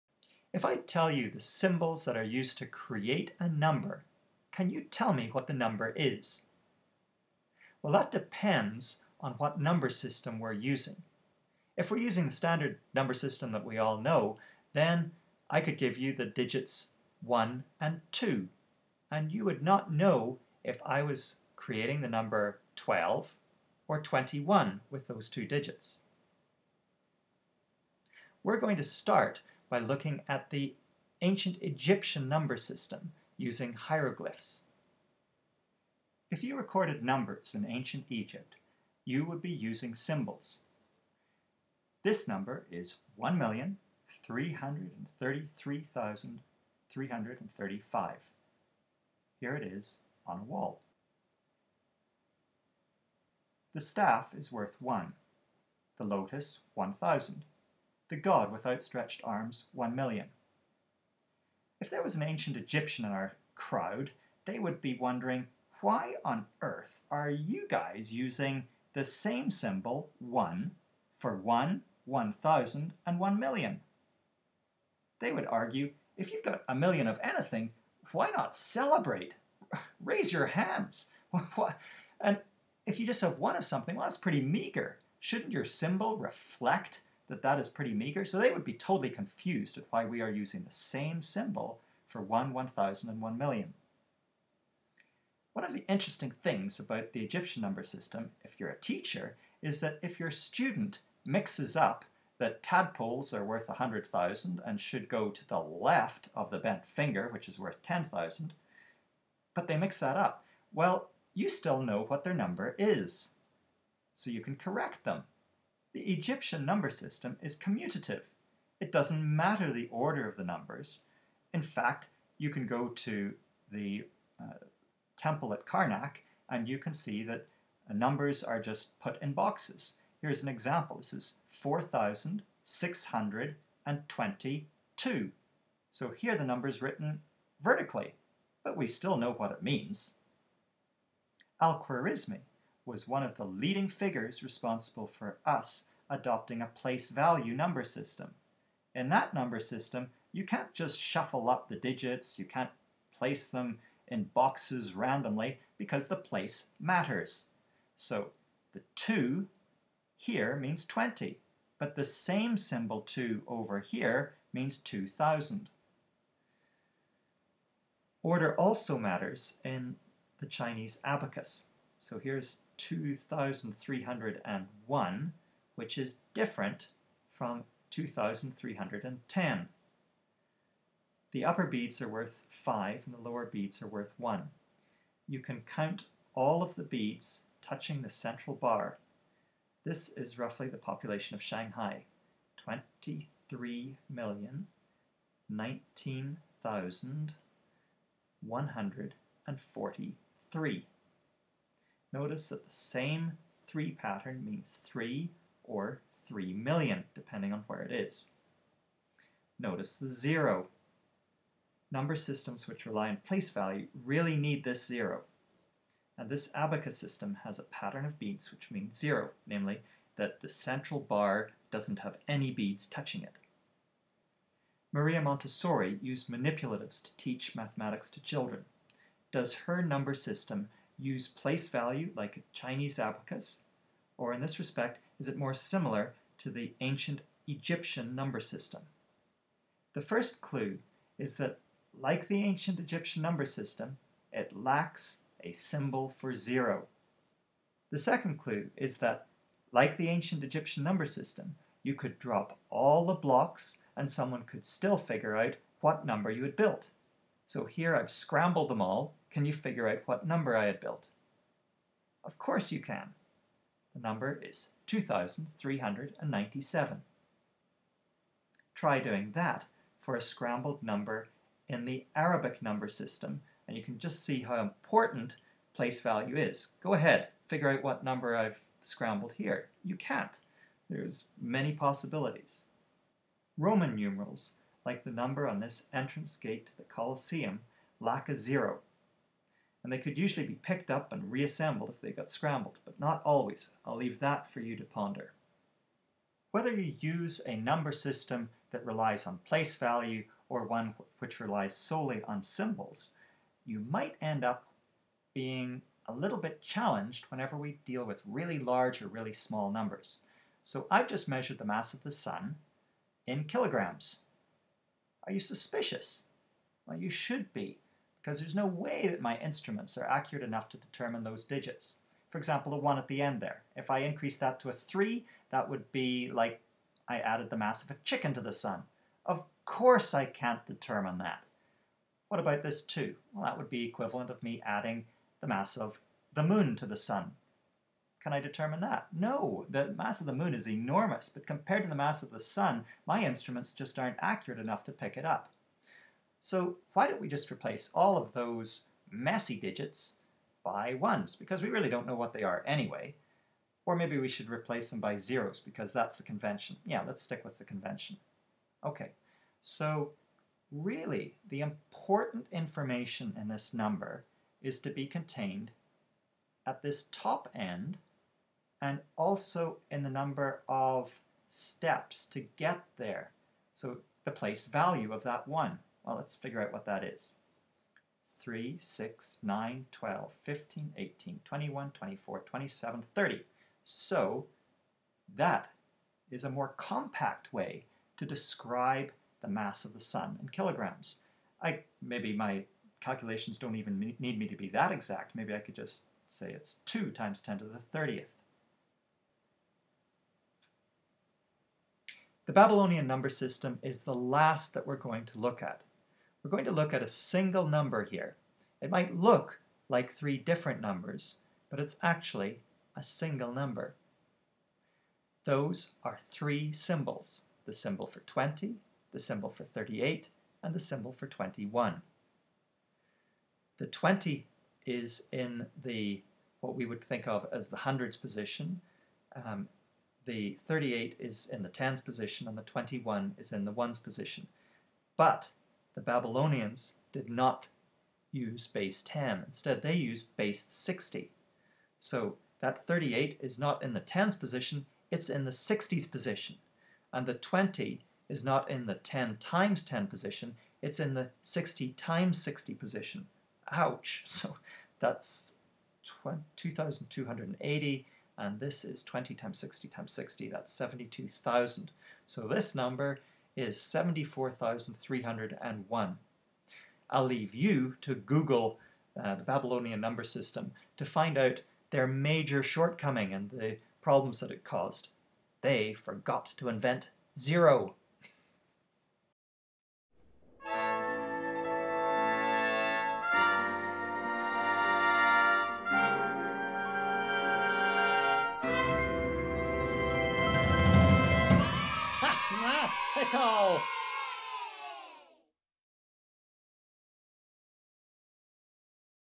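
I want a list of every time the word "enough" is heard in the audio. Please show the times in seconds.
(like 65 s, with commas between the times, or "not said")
320 s, 344 s.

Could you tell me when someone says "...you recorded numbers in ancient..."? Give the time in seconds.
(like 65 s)
36 s.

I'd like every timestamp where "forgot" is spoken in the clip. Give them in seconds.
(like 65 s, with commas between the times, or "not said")
475 s.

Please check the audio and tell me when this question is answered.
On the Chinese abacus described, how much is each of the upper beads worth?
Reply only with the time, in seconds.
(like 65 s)
182 s.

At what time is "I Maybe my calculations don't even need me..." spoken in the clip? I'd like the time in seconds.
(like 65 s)
391 s.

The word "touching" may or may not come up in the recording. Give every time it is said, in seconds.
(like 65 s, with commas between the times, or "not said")
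187 s, 222 s.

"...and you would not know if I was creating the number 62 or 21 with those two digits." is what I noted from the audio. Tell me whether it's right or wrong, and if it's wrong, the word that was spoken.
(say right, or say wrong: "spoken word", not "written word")
wrong: "12", not "62".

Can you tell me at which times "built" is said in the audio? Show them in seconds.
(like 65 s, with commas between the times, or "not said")
256 s, 260 s.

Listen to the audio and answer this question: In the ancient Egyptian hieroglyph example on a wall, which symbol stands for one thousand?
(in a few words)
the lotus.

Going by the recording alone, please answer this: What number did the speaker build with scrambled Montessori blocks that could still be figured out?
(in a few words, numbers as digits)
2,397.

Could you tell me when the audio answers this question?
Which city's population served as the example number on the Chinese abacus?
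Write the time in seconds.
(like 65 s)
191 s.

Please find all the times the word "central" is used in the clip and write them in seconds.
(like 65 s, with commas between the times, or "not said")
188 s, 220 s.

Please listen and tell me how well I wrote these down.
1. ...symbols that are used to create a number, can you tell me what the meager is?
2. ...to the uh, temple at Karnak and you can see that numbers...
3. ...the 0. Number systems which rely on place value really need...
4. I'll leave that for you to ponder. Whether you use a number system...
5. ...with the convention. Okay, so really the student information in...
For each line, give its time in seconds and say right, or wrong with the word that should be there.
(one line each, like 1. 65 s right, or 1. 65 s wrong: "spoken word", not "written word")
1. 1 s wrong: "number", not "meager"
2. 122 s right
3. 209 s right
4. 293 s right
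5. 357 s wrong: "important", not "student".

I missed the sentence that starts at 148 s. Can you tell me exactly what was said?
In that number system, you can't just shuffle up the digits, you can't place them in boxes randomly because the place matters.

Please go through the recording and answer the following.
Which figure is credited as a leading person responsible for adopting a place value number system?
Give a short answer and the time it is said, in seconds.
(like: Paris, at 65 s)
Al-Khwarizmi, at 141 s.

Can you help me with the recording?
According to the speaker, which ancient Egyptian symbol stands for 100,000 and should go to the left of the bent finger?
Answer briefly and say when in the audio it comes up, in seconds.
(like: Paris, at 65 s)
tadpoles, at 102 s.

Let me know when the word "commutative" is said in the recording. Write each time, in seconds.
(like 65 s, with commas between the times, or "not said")
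117 s.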